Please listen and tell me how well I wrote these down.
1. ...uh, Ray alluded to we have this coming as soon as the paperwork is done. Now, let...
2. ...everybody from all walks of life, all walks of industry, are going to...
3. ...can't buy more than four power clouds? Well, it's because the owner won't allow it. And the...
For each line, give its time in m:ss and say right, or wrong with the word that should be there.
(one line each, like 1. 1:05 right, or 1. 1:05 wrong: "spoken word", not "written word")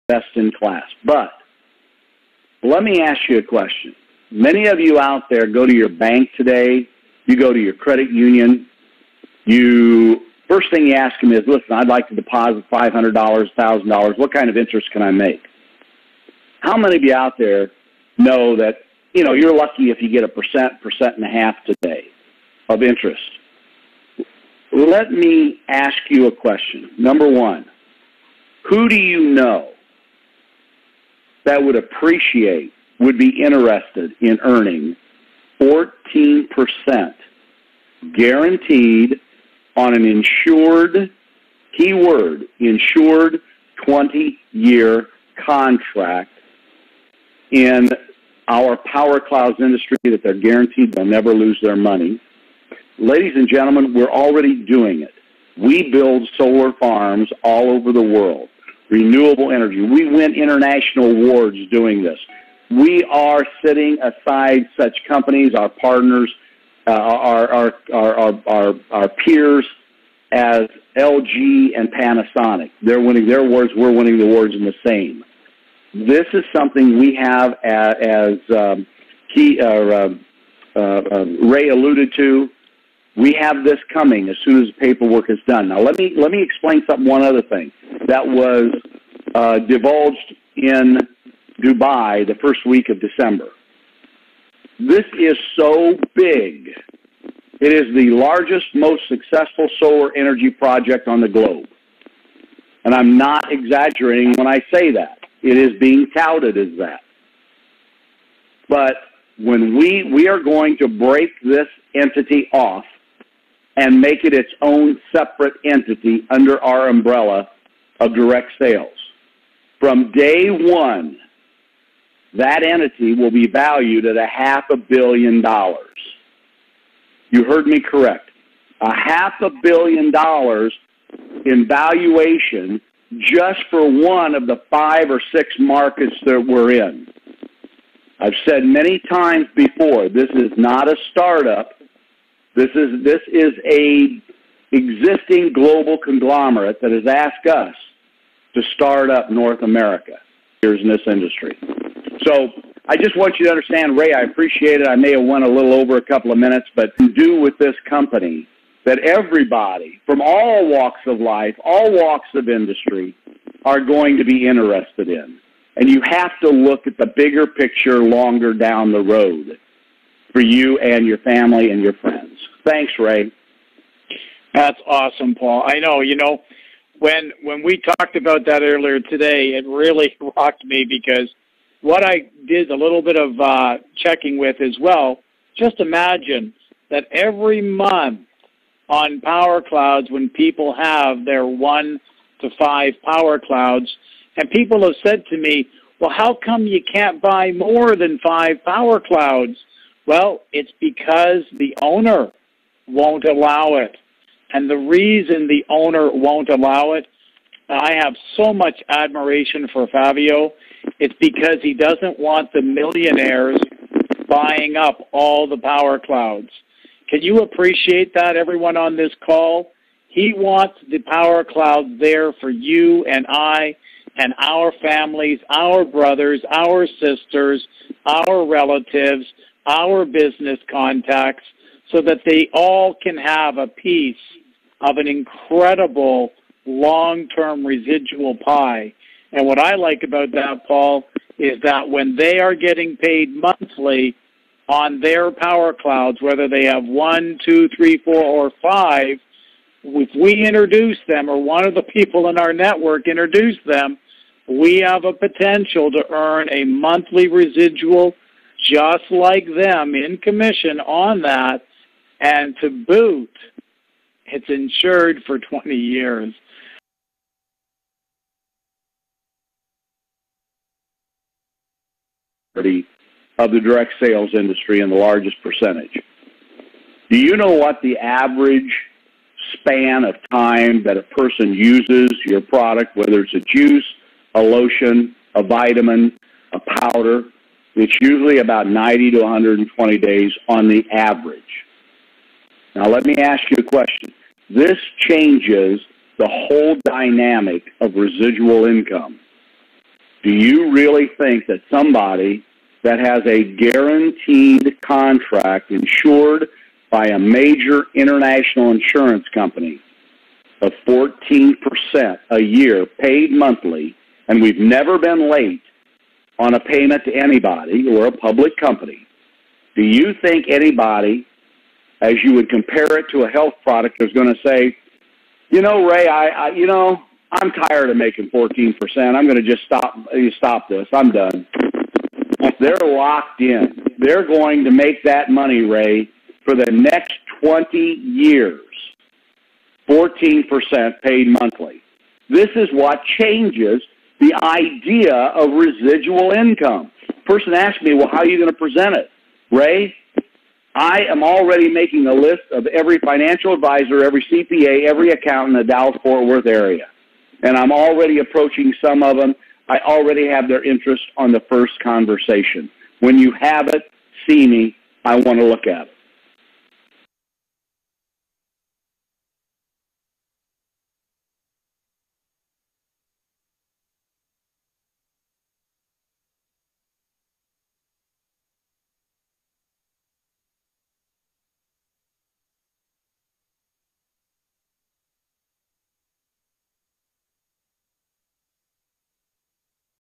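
1. 1:20 right
2. 2:38 right
3. 3:16 wrong: "five", not "four".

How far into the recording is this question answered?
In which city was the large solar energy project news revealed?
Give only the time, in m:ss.
1:31.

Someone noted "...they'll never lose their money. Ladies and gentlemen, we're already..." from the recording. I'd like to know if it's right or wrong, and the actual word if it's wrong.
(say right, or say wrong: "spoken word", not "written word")
right.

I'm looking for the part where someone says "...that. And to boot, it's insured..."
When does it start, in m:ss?
4:21.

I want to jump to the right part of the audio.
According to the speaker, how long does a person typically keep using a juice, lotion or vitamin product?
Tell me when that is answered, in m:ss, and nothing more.
4:48.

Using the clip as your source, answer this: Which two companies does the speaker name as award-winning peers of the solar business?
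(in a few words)
LG and Panasonic.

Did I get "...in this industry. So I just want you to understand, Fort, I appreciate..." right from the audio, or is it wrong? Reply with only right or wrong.
wrong.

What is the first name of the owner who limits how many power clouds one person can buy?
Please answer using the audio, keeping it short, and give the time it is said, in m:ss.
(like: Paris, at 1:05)
Fabio, at 3:29.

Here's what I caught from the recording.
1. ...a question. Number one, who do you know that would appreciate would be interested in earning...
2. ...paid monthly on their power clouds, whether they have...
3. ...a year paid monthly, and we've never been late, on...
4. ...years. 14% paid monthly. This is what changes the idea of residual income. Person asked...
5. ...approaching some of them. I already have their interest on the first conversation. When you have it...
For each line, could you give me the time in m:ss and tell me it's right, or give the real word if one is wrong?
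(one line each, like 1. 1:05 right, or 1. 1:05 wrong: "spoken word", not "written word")
1. 0:26 right
2. 4:02 right
3. 5:12 right
4. 5:37 right
5. 5:58 right.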